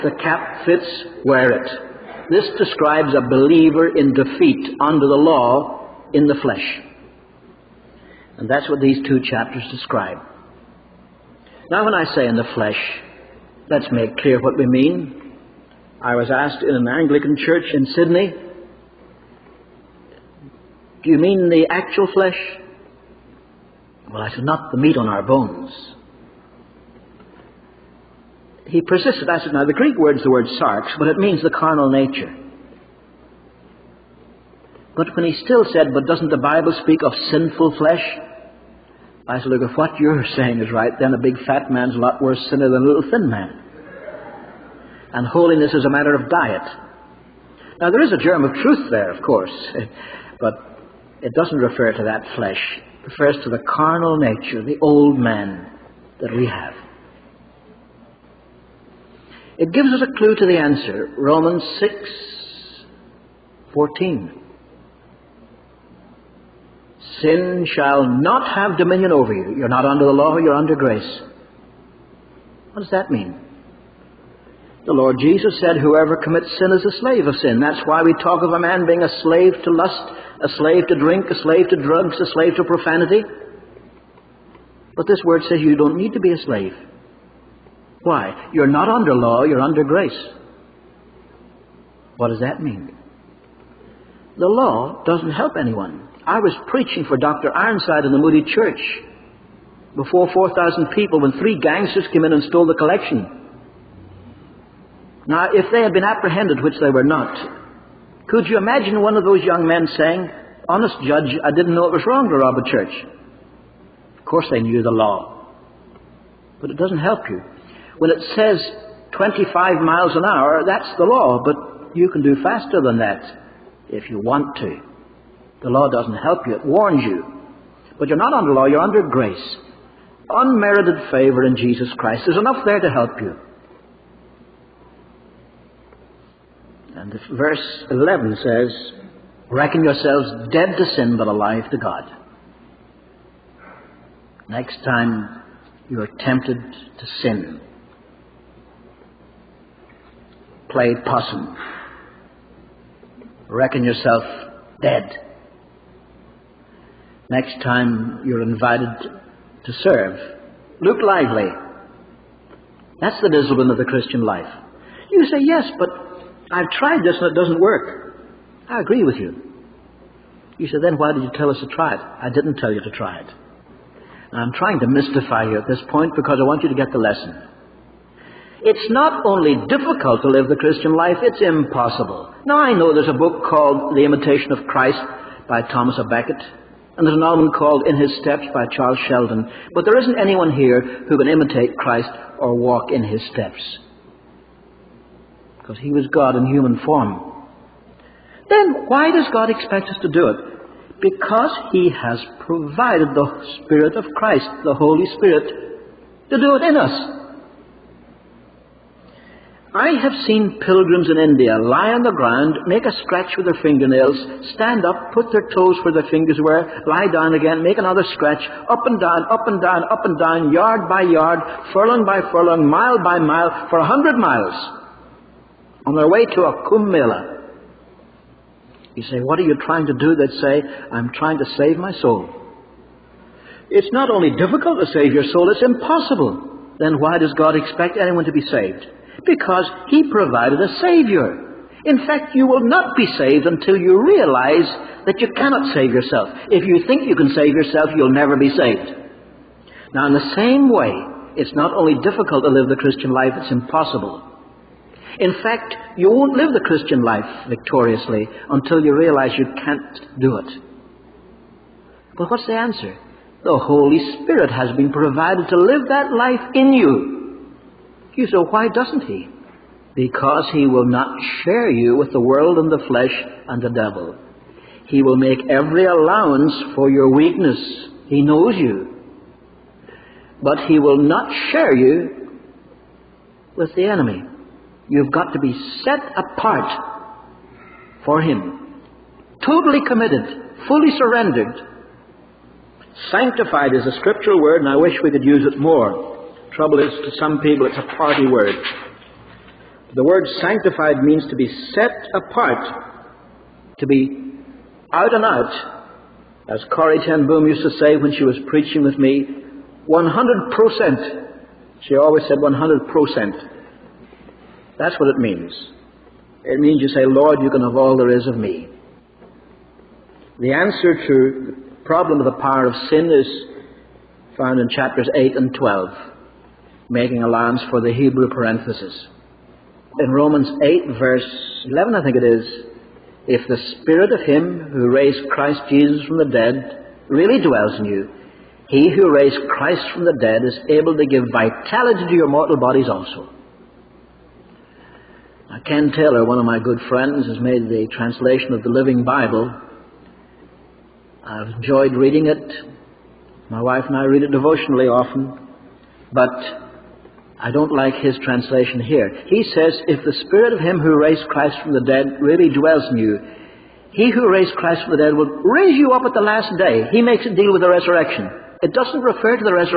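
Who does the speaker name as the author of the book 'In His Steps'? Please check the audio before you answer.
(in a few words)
Charles Sheldon.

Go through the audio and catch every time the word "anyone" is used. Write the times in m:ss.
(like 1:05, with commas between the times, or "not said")
1:35, 3:10, 3:57.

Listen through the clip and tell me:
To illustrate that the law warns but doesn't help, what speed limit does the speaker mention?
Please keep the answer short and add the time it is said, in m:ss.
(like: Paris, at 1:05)
25 miles an hour, at 1:59.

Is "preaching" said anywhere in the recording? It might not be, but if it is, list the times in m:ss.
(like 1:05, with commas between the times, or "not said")
1:36, 5:08.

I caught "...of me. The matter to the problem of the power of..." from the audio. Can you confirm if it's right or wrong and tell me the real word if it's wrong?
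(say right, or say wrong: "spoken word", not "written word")
wrong: "answer", not "matter".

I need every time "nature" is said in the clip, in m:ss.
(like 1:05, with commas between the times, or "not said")
0:31, 0:54.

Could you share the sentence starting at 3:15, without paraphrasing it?
Because He was God in human form.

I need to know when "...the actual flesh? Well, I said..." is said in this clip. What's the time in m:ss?
0:21.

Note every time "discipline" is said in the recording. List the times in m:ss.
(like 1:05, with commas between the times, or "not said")
2:43.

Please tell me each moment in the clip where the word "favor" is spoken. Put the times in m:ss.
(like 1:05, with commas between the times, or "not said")
2:11.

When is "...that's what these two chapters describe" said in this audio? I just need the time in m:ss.
0:08.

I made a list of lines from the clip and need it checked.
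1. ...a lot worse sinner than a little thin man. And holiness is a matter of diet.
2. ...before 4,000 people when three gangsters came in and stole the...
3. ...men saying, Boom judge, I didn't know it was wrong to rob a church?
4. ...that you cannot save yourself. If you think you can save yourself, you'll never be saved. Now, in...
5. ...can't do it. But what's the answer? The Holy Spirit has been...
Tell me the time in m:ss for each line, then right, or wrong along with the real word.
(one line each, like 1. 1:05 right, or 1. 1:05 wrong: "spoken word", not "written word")
1. 0:41 right
2. 1:39 right
3. 1:49 wrong: "Honest", not "Boom"
4. 4:05 right
5. 4:19 right.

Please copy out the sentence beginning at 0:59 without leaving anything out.
It gives us a clue to the answer.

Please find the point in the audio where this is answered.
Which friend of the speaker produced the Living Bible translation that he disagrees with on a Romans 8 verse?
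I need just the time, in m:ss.
5:45.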